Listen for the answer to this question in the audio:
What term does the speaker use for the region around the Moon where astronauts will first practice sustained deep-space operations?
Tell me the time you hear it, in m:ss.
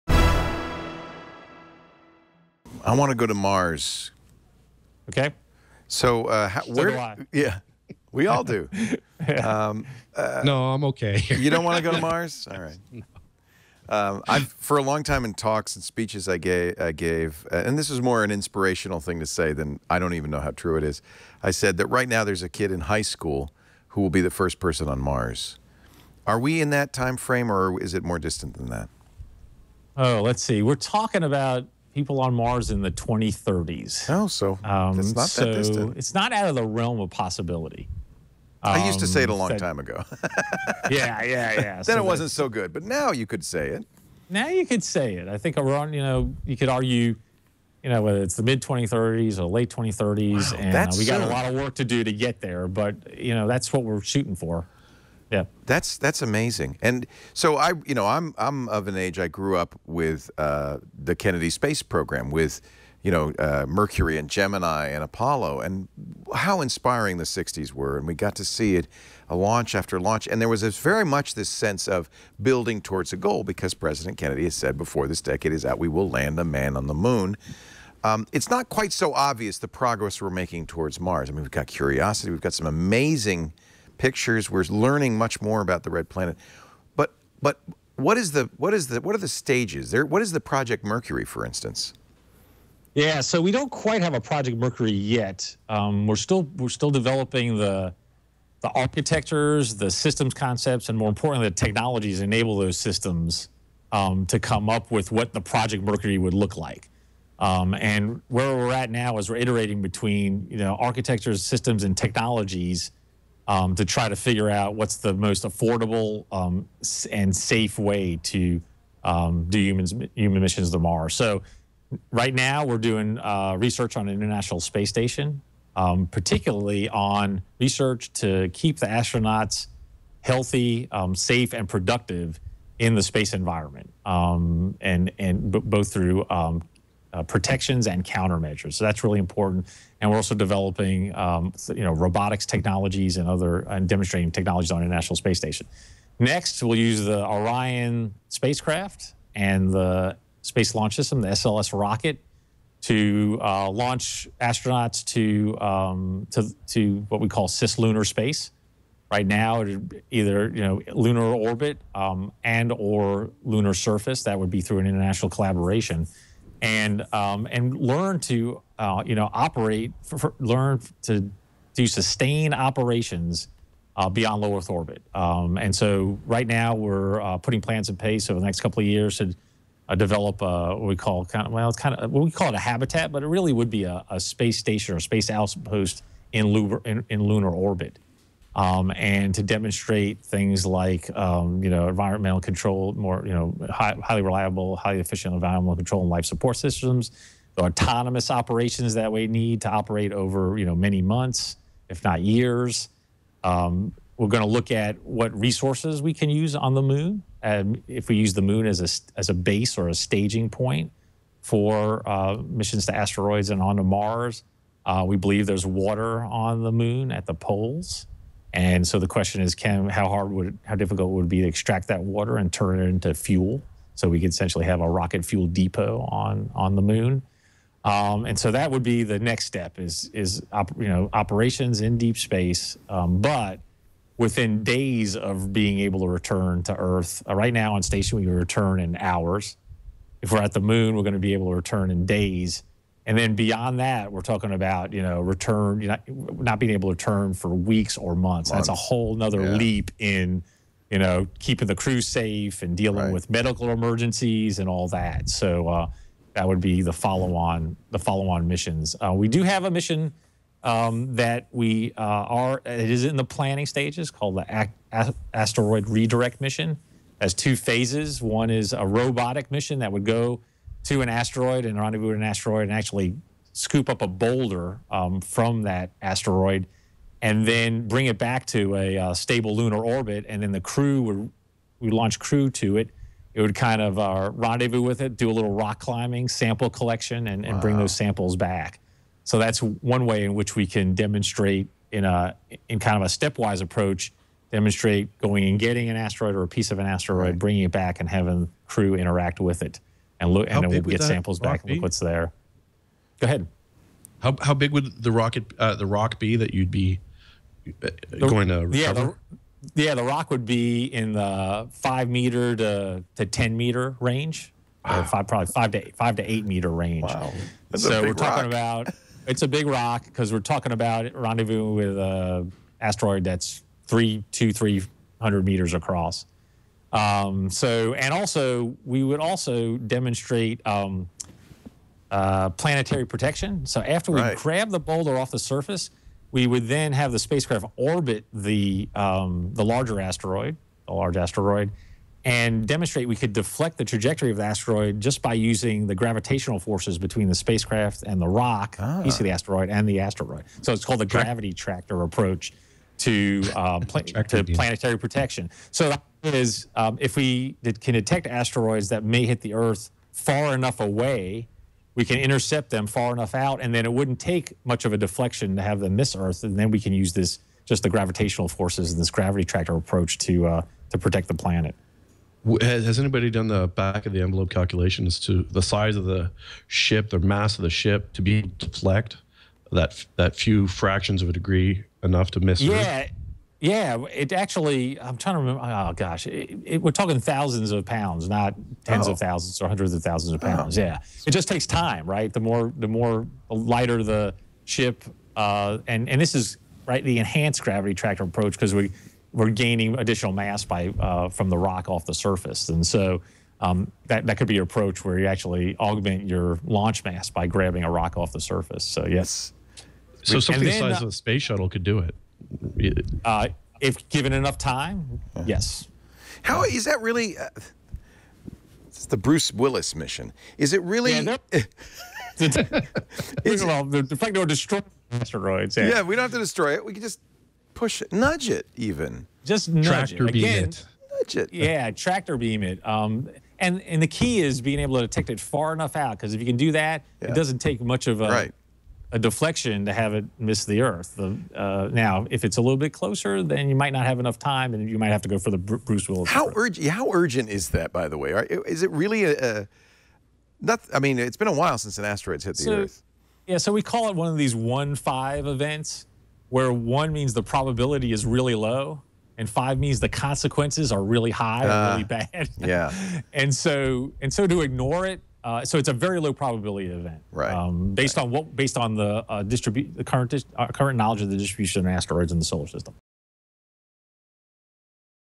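2:37.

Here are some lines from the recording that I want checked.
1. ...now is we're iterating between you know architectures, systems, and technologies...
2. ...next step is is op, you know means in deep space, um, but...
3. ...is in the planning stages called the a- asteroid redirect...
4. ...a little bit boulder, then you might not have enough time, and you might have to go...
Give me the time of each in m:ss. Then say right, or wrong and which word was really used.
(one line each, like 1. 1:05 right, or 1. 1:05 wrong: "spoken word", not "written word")
1. 1:48 right
2. 3:49 wrong: "operations", not "means"
3. 4:22 right
4. 7:22 wrong: "closer", not "boulder".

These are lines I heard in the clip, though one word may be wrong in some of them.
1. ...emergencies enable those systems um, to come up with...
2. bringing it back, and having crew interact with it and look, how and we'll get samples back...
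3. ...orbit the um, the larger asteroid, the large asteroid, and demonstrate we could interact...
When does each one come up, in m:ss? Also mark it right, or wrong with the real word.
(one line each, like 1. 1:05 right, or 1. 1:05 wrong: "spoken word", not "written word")
1. 1:41 wrong: "technologies", not "emergencies"
2. 4:57 right
3. 5:37 wrong: "deflect", not "interact".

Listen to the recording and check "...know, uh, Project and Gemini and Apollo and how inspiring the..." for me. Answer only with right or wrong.
wrong.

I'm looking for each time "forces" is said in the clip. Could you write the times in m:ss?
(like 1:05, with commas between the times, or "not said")
5:46, 6:08.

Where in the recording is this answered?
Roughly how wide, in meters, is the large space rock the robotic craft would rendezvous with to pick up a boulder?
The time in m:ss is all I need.
5:24.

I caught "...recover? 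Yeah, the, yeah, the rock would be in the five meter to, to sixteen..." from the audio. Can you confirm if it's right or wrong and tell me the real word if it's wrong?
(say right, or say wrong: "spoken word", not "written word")
wrong: "ten", not "sixteen".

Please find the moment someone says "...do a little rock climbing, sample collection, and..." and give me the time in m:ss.
4:45.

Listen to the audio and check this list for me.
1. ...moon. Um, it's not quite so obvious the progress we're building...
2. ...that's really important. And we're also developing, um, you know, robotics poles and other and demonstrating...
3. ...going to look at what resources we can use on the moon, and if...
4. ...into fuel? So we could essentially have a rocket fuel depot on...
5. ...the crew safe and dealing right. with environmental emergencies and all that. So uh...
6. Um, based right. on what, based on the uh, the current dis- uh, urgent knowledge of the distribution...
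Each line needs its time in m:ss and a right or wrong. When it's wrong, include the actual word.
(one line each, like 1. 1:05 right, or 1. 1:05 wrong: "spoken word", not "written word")
1. 1:16 wrong: "making", not "building"
2. 2:18 wrong: "technologies", not "poles"
3. 3:24 right
4. 3:42 right
5. 4:11 wrong: "medical", not "environmental"
6. 7:47 wrong: "current", not "urgent".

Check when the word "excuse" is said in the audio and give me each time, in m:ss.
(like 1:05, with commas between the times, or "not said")
not said.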